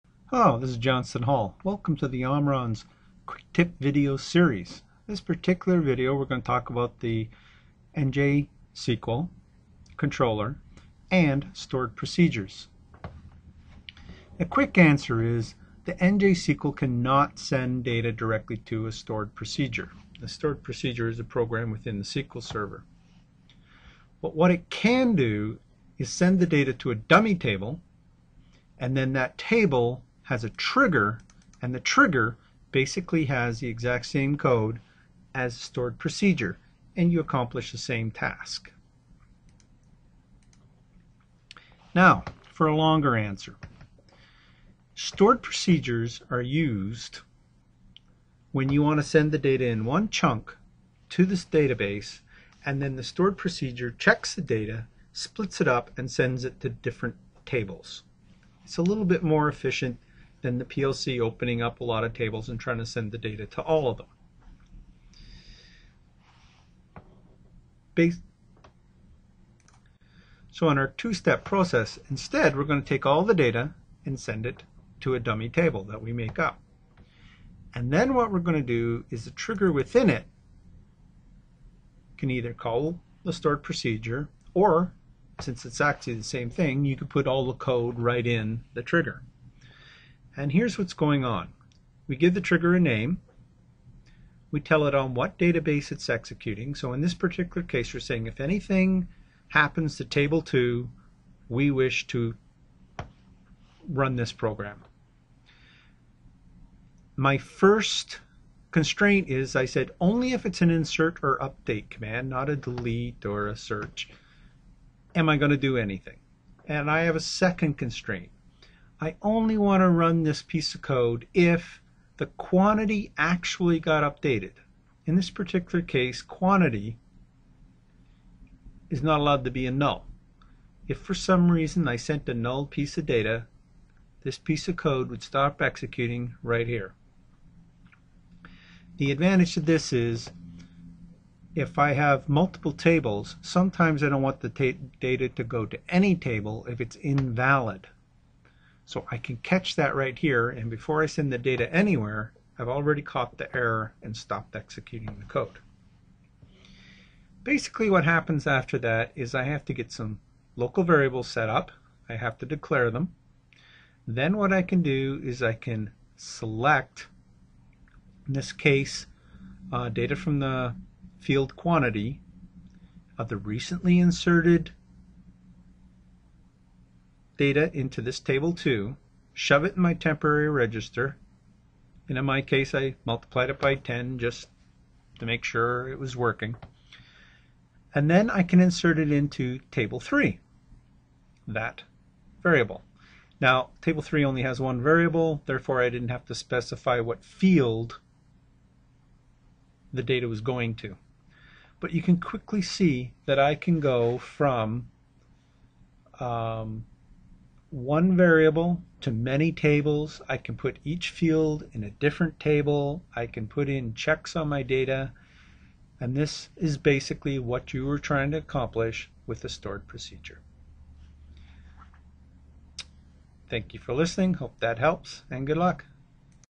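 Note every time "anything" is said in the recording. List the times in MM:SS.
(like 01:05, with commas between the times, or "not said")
01:38, 01:55.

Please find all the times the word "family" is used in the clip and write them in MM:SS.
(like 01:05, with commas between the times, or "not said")
not said.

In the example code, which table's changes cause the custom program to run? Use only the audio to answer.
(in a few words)
Table 2.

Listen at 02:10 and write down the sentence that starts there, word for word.
If for some reason I sent a null piece of data, this piece of code would stop executing right here.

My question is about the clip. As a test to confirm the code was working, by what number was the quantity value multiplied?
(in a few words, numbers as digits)
10.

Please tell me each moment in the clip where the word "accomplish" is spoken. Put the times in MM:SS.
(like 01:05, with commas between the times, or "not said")
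00:37, 03:38.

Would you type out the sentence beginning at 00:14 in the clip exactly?
The quick answer is the NJ SQL cannot send data directly to a stored procedure.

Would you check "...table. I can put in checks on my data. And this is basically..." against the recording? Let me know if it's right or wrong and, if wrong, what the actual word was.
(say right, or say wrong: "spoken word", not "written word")
right.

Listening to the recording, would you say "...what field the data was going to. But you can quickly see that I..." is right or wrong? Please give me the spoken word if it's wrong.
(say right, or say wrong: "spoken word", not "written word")
right.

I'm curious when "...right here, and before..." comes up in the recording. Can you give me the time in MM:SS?
02:29.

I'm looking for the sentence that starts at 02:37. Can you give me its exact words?
Basically what happens after that is I have to get some local variables set up.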